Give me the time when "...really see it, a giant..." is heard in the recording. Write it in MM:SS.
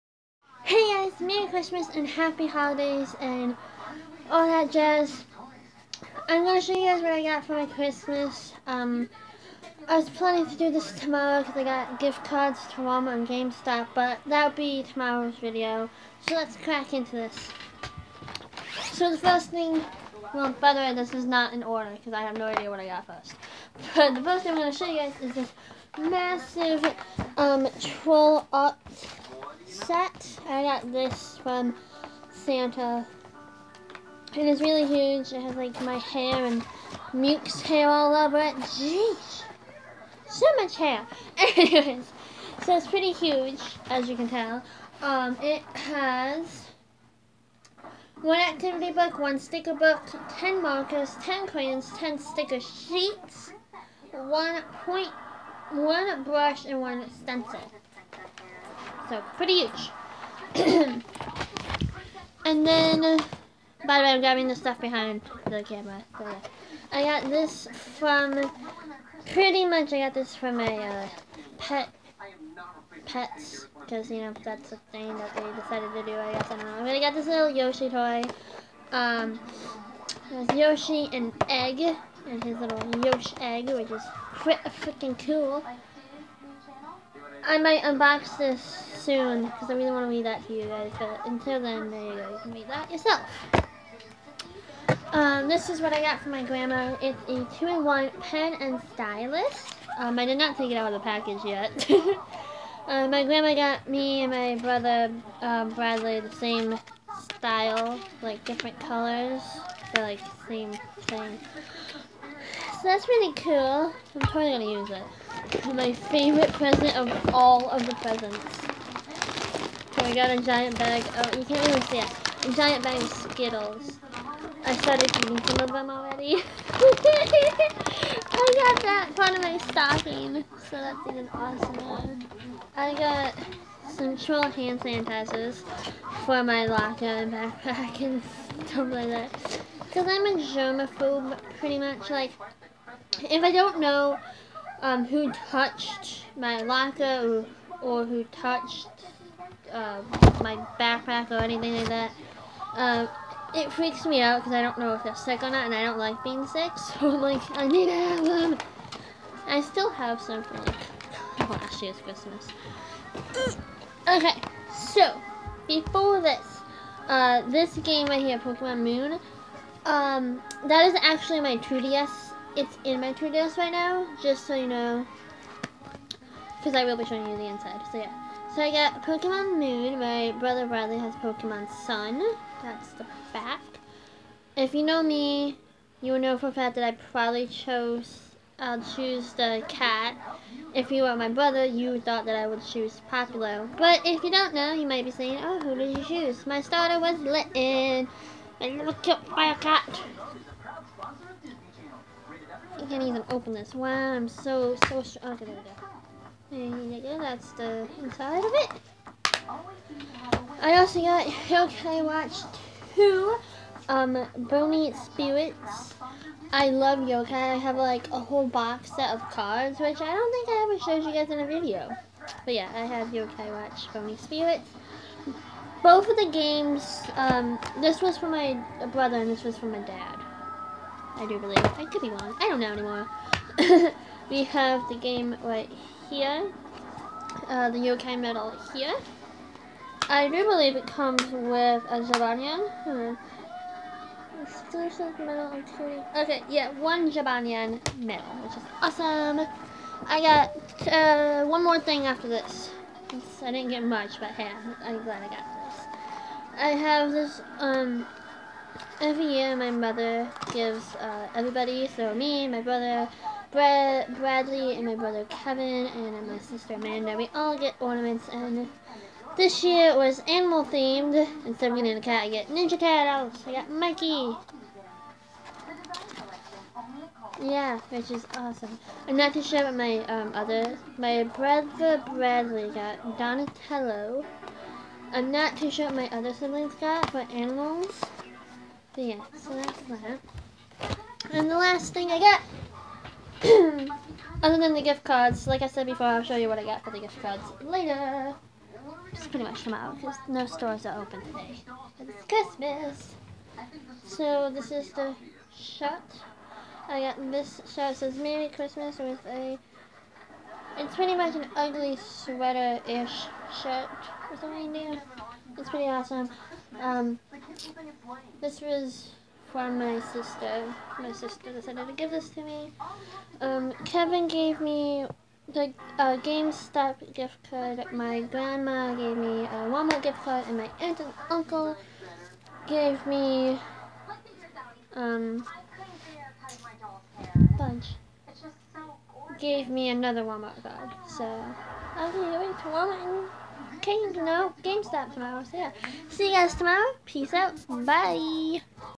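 02:01.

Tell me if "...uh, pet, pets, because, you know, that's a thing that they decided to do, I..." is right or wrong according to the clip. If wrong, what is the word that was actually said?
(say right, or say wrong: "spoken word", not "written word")
right.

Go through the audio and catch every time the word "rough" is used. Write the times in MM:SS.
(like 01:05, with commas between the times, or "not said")
not said.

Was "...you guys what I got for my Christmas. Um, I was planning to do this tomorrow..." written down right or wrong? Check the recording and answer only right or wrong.
right.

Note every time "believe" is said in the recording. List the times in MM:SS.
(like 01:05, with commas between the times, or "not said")
03:51, 04:00.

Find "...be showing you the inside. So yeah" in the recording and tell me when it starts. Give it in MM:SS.
02:56.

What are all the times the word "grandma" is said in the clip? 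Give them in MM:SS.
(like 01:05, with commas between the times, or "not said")
01:36, 01:43, 05:28.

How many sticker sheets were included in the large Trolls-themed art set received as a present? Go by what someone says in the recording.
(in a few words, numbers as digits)
10.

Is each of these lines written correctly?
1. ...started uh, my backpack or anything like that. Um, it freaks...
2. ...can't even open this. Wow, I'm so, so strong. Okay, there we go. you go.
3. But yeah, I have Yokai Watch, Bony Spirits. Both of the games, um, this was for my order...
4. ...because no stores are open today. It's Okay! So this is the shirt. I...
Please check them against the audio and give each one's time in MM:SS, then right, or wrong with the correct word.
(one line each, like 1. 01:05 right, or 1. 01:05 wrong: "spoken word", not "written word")
1. 02:28 wrong: "touched", not "started"
2. 03:22 right
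3. 03:42 wrong: "brother", not "order"
4. 04:59 wrong: "Christmas", not "Okay".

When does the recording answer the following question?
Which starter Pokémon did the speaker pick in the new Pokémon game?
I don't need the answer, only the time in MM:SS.
03:17.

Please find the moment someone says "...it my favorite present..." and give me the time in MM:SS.
01:54.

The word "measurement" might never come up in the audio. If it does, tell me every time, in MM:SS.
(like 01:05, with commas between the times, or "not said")
not said.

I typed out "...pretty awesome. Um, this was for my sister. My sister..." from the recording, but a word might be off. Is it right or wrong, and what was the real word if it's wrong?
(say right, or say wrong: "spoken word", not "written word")
right.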